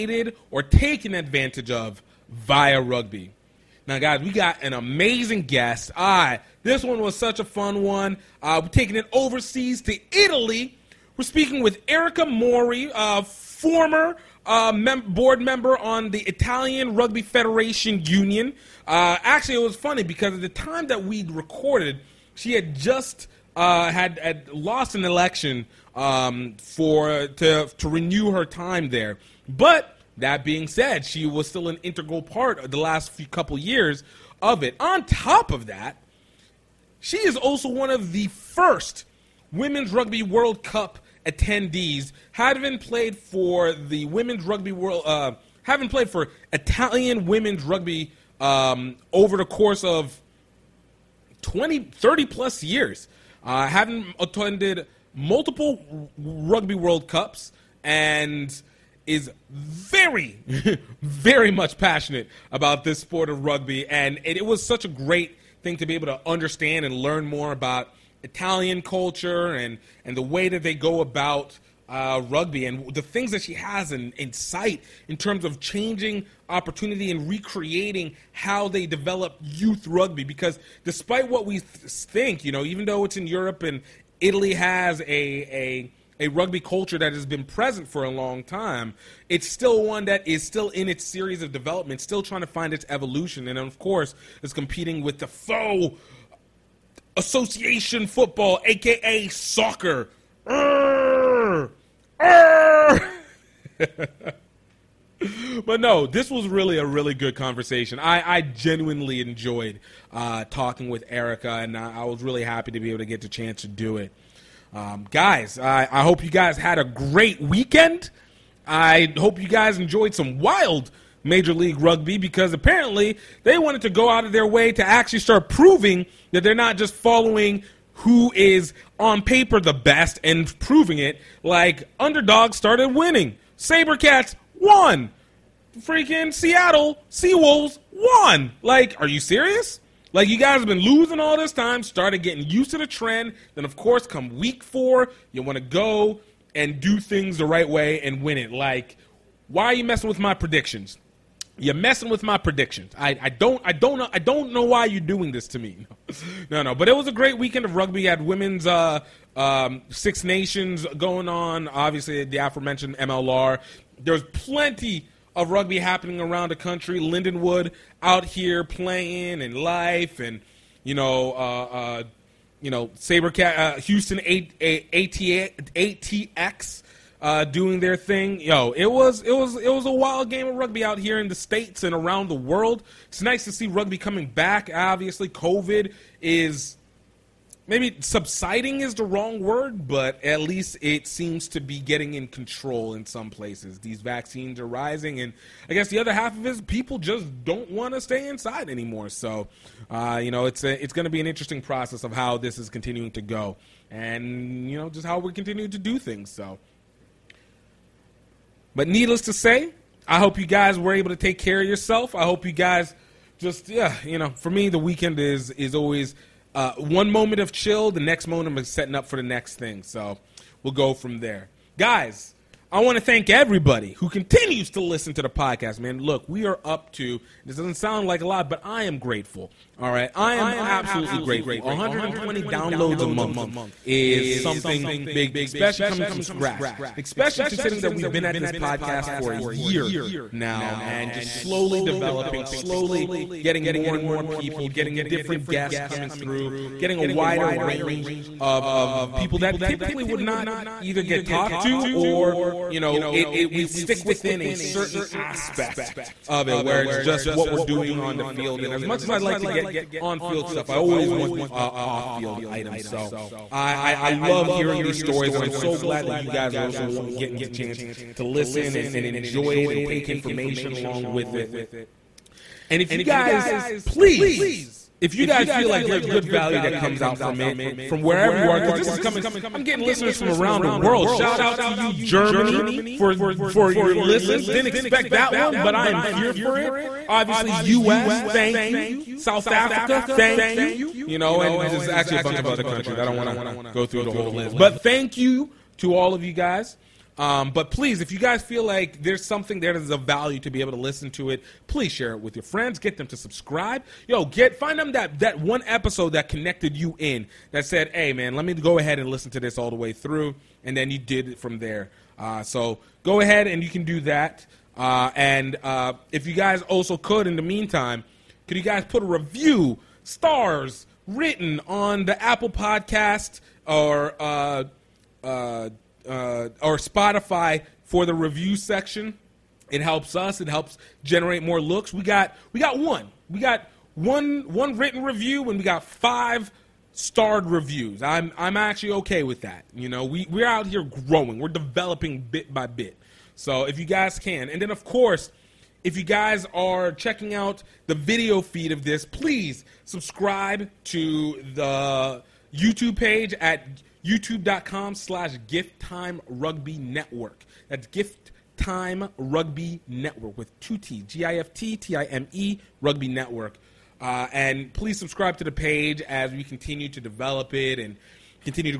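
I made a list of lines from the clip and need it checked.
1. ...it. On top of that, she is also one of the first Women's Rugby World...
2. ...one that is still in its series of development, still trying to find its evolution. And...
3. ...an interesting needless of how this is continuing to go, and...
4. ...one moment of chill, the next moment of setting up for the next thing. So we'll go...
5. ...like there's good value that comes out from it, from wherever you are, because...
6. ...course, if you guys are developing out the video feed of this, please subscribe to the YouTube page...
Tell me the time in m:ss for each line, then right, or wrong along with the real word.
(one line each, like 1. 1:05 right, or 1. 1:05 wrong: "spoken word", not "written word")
1. 0:34 right
2. 1:29 right
3. 3:21 wrong: "process", not "needless"
4. 3:36 right
5. 4:35 right
6. 5:44 wrong: "checking", not "developing".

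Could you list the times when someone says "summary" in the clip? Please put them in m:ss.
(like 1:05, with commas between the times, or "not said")
not said.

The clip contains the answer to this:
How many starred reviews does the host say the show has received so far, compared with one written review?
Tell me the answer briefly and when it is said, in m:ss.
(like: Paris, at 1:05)
5, at 5:35.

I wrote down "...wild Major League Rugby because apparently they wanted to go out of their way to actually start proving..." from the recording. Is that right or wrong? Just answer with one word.
right.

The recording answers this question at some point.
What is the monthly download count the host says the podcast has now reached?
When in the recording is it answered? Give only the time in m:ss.
3:51.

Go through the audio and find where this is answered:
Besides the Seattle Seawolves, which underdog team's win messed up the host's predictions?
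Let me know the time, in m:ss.
2:13.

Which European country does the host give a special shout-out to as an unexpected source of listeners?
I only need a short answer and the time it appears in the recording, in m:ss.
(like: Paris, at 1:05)
Germany, at 4:41.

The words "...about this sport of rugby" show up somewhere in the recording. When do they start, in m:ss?
1:02.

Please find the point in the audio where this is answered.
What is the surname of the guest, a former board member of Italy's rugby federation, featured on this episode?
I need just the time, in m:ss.
0:11.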